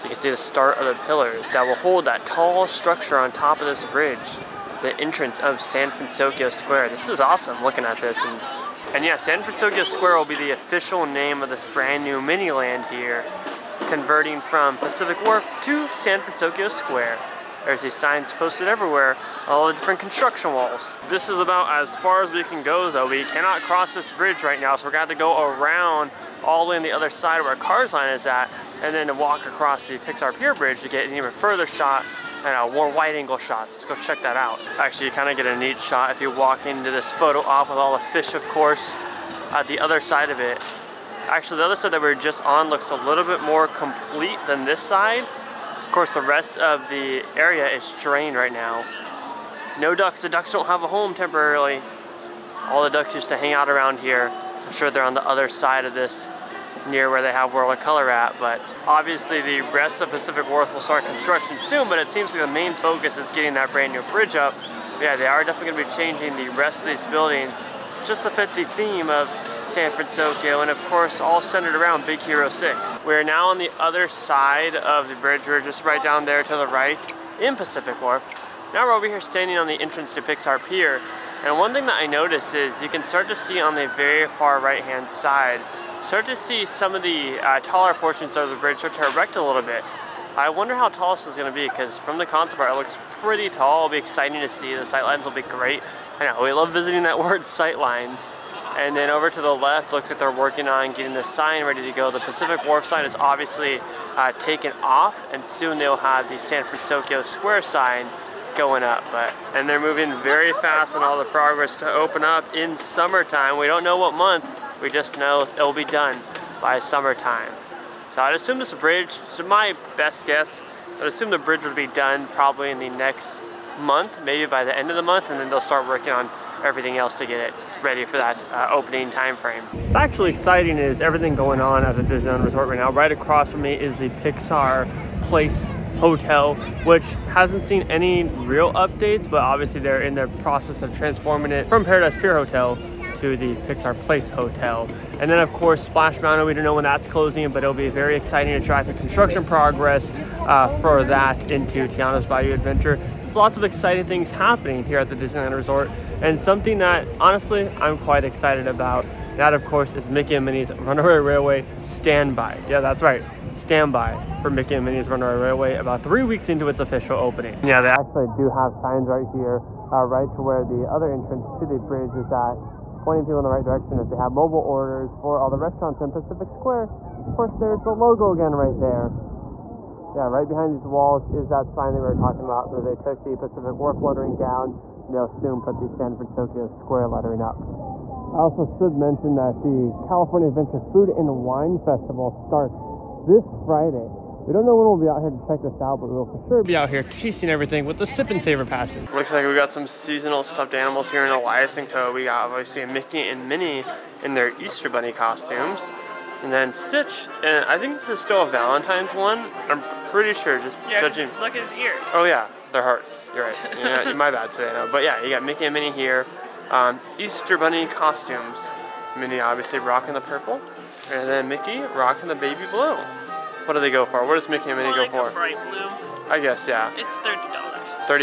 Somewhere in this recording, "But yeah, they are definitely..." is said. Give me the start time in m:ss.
1:04.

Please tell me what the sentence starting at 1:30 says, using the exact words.
I wonder how tall this is going to be because from the concept art it looks pretty tall.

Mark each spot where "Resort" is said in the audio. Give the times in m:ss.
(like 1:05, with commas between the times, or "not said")
2:12, 2:35.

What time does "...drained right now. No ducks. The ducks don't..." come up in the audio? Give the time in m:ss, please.
0:48.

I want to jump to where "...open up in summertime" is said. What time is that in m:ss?
1:51.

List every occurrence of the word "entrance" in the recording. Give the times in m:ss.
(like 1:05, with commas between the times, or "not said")
0:04, 1:19, 2:51.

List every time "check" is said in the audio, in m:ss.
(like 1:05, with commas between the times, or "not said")
0:34, 3:15.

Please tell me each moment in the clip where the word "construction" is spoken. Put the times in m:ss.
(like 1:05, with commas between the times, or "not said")
0:19, 1:01, 2:28.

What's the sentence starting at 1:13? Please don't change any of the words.
We're now on the other side of the bridge.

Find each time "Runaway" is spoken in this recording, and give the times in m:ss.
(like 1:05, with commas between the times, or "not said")
2:40, 2:45.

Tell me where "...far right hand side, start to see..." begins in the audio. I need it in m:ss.
1:24.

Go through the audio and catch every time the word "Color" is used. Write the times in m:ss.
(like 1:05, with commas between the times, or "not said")
0:57.